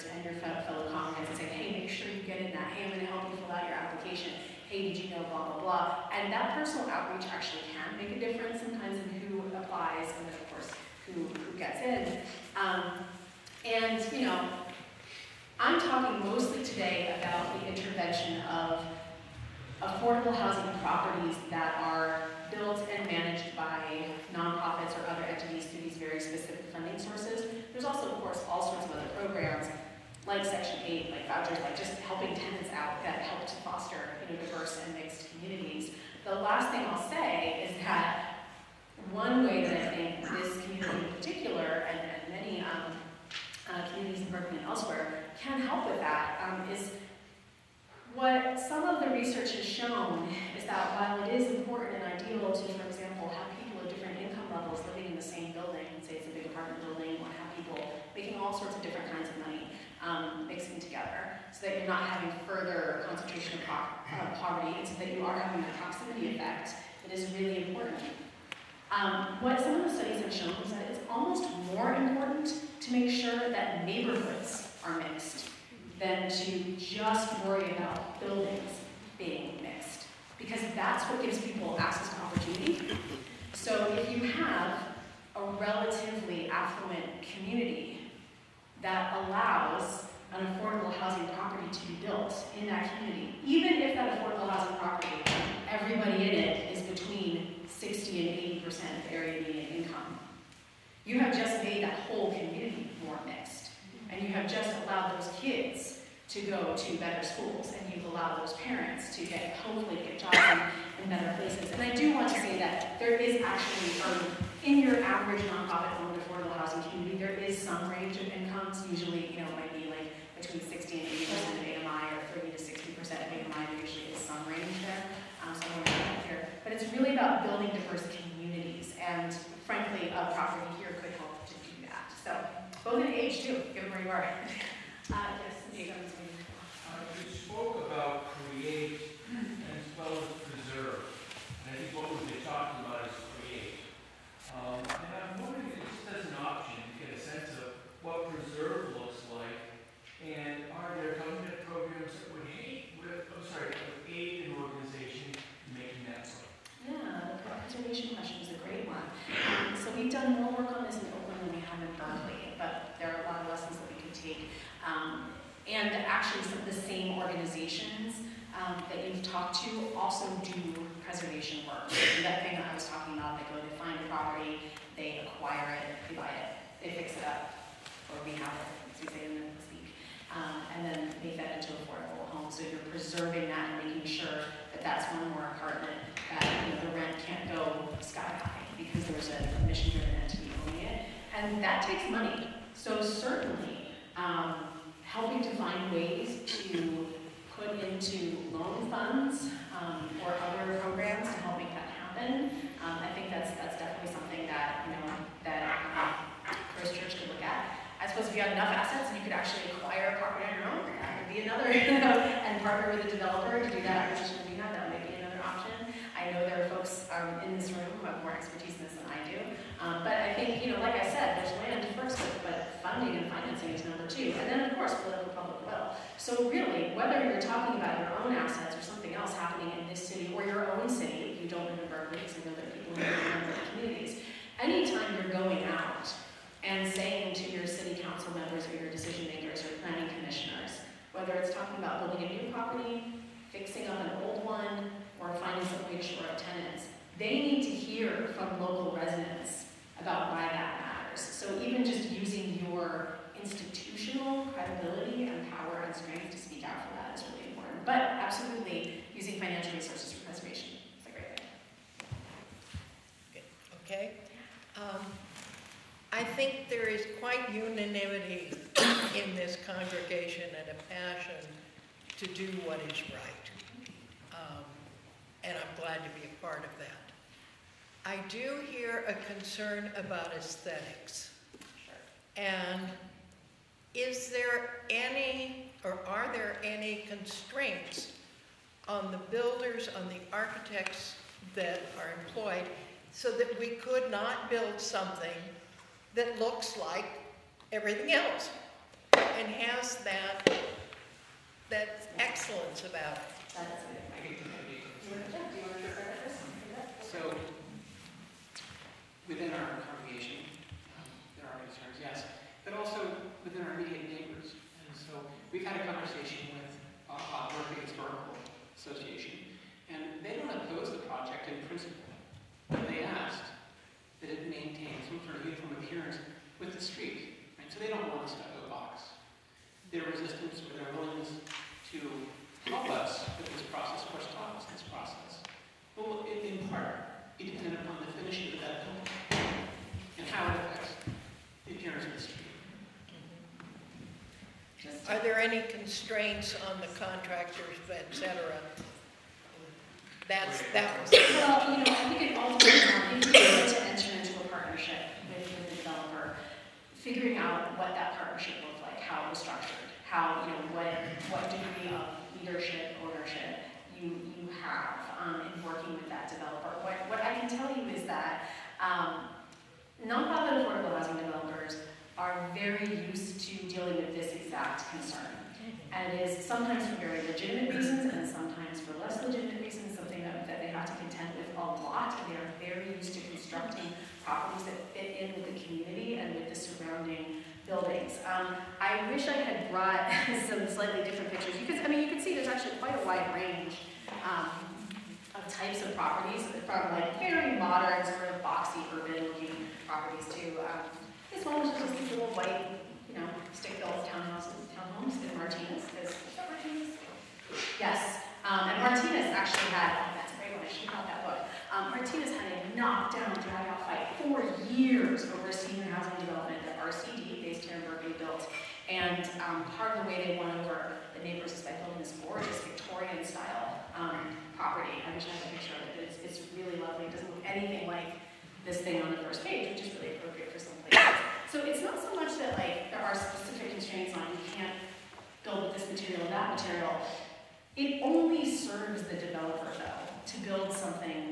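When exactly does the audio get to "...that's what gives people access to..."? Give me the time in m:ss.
1:20.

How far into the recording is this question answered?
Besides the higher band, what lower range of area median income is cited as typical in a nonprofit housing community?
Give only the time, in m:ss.
2:02.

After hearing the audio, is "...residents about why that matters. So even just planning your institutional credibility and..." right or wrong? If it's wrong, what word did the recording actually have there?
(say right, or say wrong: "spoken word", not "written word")
wrong: "using", not "planning".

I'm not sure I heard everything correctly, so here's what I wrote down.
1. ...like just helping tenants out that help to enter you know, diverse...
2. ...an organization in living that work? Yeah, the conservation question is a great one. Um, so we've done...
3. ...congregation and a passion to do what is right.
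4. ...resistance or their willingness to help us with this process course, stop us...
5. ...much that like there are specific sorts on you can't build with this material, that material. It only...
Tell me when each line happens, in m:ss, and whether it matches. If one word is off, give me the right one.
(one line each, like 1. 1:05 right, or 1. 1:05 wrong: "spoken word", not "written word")
1. 0:31 wrong: "foster", not "enter"
2. 2:34 wrong: "making", not "living"
3. 4:29 right
4. 5:30 right
5. 7:12 wrong: "constraints", not "sorts".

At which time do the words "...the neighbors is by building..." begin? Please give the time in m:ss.
7:01.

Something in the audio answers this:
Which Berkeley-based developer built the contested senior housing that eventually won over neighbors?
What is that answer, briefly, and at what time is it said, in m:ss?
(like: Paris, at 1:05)
RCD, at 6:56.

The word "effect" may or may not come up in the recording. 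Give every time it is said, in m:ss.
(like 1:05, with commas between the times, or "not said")
1:06.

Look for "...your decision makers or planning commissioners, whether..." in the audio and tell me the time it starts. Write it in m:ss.
3:58.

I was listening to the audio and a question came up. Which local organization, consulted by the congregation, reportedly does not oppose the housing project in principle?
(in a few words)
Berkeley Historical Association.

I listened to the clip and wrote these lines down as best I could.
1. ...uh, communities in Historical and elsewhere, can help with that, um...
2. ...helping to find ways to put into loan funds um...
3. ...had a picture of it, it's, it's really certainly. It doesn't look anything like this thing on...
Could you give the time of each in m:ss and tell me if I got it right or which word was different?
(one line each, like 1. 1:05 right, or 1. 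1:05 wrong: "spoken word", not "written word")
1. 0:43 wrong: "Berkeley", not "Historical"
2. 3:15 right
3. 7:05 wrong: "lovely", not "certainly".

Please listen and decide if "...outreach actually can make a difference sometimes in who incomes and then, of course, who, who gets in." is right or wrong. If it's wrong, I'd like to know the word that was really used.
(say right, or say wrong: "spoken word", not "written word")
wrong: "applies", not "incomes".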